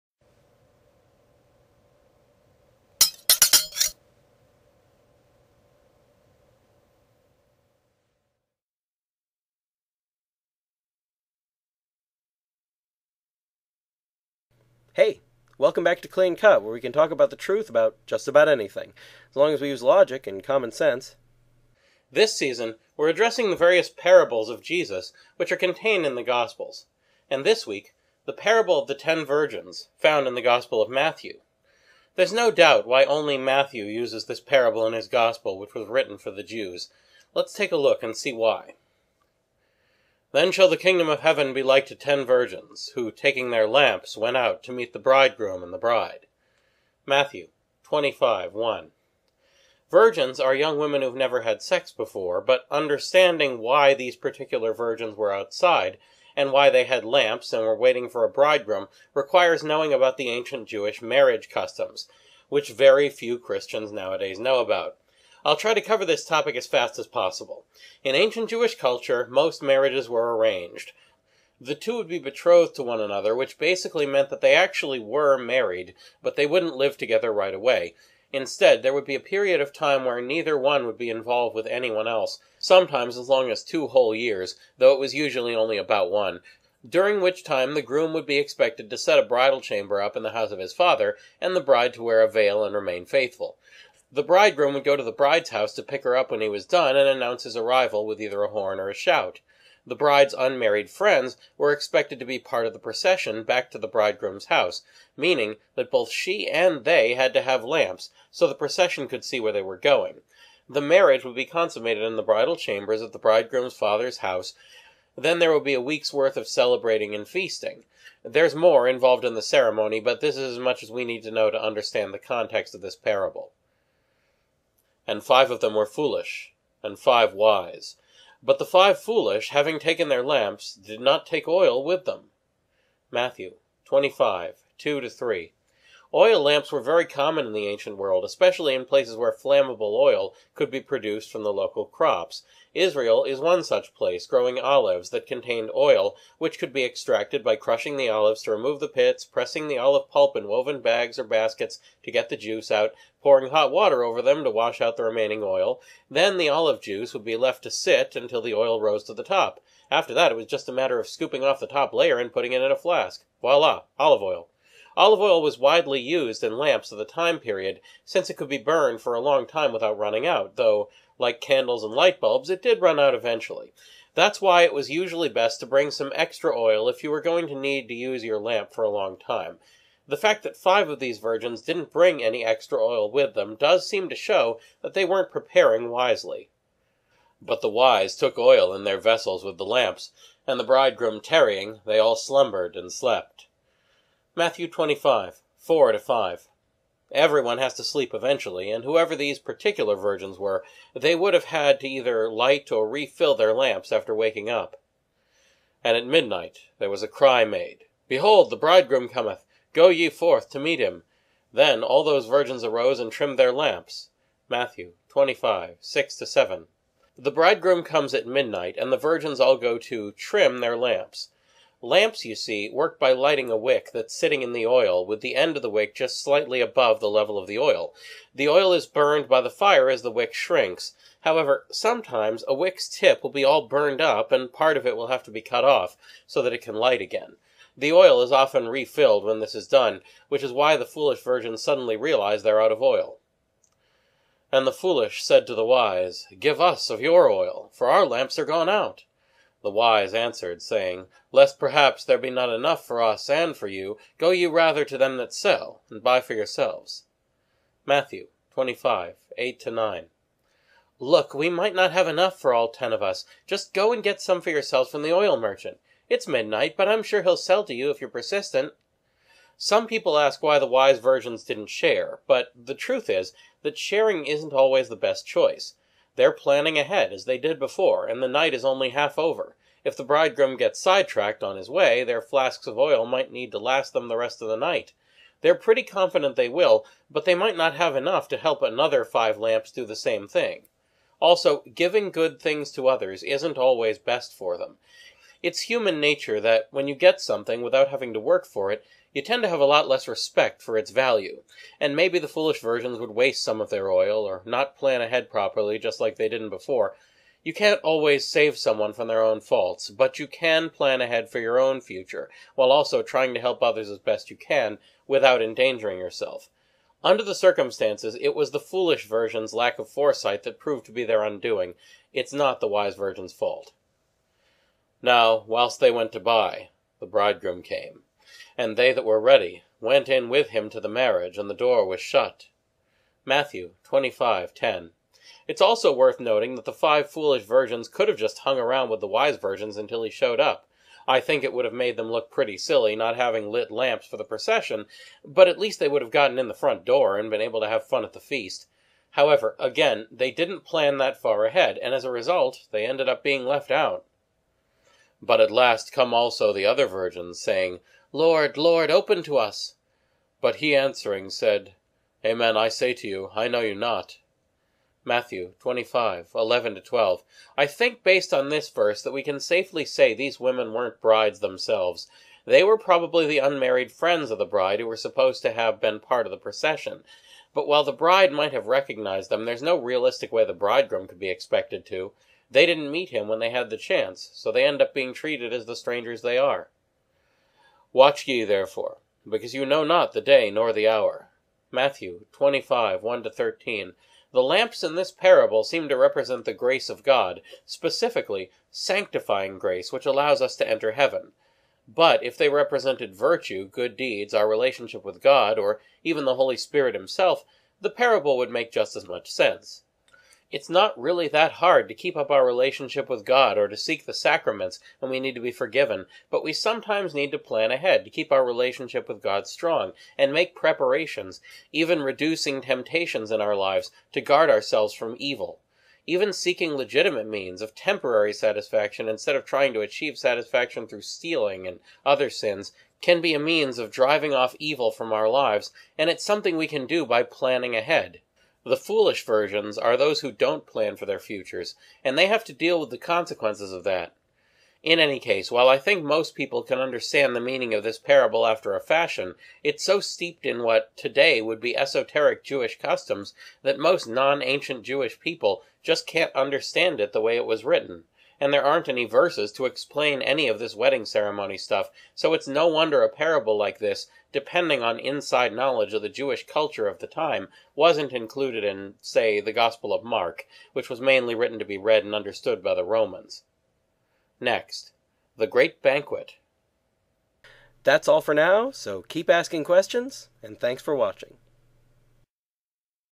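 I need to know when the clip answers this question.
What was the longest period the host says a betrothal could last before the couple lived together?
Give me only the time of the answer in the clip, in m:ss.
1:23.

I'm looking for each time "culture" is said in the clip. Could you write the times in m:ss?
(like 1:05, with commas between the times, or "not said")
1:08, 7:46.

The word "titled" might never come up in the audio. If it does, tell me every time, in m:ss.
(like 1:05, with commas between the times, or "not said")
not said.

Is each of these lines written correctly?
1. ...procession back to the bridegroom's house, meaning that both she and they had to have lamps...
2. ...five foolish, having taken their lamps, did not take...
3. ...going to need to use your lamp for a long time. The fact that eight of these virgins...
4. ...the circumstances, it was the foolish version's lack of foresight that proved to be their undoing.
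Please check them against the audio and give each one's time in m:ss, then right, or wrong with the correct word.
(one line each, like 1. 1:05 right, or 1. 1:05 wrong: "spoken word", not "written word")
1. 1:42 right
2. 2:08 right
3. 2:57 wrong: "five", not "eight"
4. 5:17 right.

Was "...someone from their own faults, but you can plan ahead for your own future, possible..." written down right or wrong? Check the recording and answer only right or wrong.
wrong.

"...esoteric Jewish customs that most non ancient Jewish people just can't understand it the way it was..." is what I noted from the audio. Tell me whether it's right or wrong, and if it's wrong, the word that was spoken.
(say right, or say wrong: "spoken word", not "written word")
right.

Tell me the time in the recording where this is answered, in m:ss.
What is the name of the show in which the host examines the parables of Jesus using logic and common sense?
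0:16.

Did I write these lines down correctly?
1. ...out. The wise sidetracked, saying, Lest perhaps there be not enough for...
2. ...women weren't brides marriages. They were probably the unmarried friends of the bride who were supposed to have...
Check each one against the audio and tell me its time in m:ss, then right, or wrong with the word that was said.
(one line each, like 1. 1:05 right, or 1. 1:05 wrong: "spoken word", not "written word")
1. 4:08 wrong: "answered", not "sidetracked"
2. 6:10 wrong: "themselves", not "marriages".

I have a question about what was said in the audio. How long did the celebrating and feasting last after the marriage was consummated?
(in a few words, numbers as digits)
A week.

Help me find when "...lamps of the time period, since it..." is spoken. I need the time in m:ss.
2:46.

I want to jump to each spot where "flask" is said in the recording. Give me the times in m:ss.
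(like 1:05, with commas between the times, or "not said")
2:42, 4:42.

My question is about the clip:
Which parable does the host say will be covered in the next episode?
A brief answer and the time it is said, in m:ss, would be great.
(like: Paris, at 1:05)
The Great Banquet, at 7:55.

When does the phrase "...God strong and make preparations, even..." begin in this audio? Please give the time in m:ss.
6:59.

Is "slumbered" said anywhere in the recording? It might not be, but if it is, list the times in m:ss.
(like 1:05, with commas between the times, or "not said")
3:12.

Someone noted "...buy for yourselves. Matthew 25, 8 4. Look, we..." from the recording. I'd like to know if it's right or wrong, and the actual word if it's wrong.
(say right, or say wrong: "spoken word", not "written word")
wrong: "9", not "4".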